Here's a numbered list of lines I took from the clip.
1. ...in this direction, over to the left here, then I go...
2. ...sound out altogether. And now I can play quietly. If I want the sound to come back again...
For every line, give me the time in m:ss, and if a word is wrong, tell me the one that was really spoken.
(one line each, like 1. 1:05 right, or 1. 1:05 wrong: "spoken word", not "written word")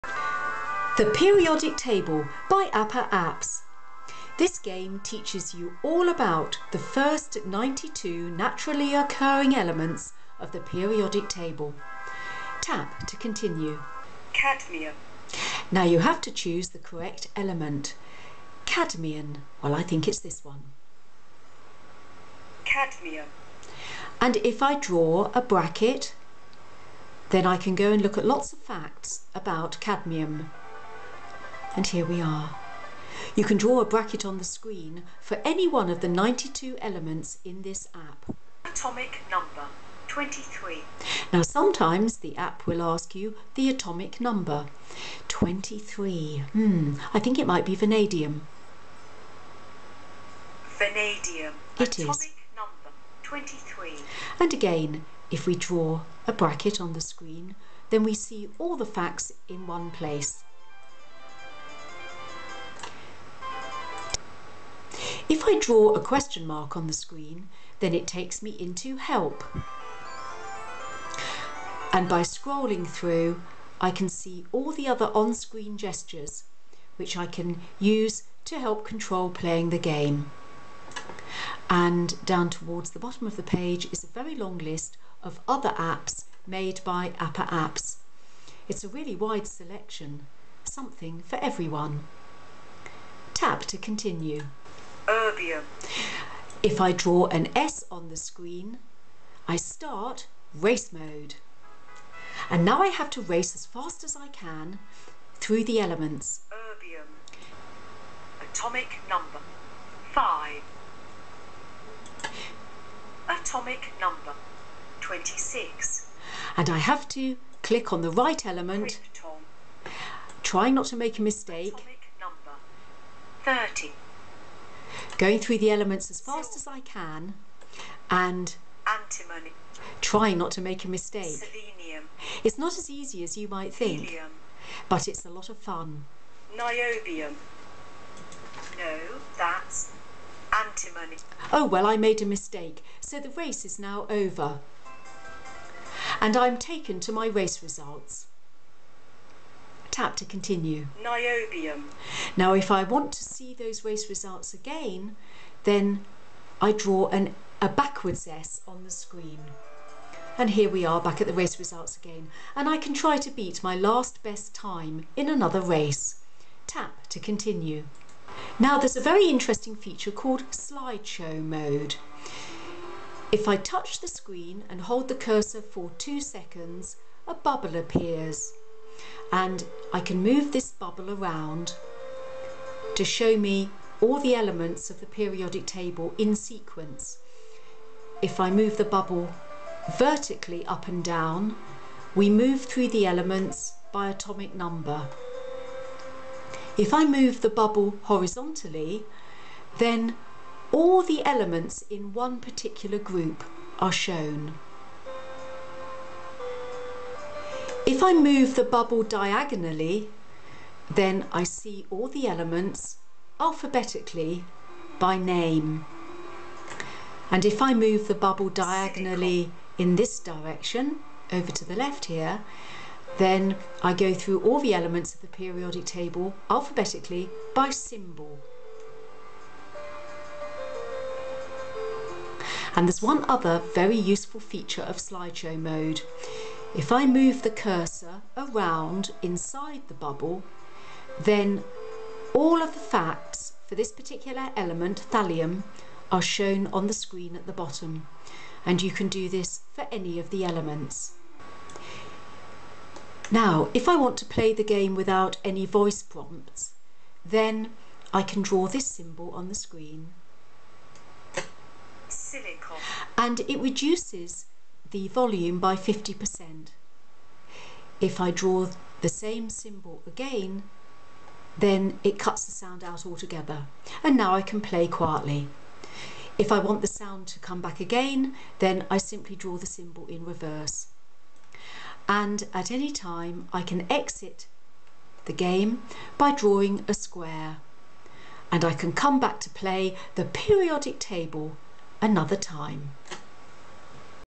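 1. 3:39 right
2. 4:32 right.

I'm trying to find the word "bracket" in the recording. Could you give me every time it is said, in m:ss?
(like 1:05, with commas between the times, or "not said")
0:25, 0:33, 0:56.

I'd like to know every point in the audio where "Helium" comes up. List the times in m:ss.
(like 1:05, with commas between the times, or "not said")
2:14.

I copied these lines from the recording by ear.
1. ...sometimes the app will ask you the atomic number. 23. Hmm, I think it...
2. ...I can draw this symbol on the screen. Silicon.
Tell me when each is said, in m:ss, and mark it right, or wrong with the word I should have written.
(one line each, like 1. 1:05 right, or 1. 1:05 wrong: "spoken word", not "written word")
1. 0:41 right
2. 4:18 right.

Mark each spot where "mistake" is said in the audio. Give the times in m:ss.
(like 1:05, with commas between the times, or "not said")
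2:01, 2:10, 2:22.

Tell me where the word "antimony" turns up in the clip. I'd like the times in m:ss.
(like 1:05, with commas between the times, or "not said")
2:08, 2:20.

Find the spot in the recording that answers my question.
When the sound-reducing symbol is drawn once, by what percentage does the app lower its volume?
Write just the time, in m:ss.
4:25.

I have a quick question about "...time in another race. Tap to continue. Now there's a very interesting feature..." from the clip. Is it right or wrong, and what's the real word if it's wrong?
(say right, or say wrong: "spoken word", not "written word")
right.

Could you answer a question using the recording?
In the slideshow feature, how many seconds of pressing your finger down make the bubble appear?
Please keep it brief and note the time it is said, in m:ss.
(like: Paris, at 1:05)
2, at 2:55.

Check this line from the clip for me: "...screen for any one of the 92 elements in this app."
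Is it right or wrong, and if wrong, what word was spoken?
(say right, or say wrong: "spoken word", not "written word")
right.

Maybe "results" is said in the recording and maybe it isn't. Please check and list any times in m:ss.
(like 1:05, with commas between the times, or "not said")
2:27, 2:34, 2:41.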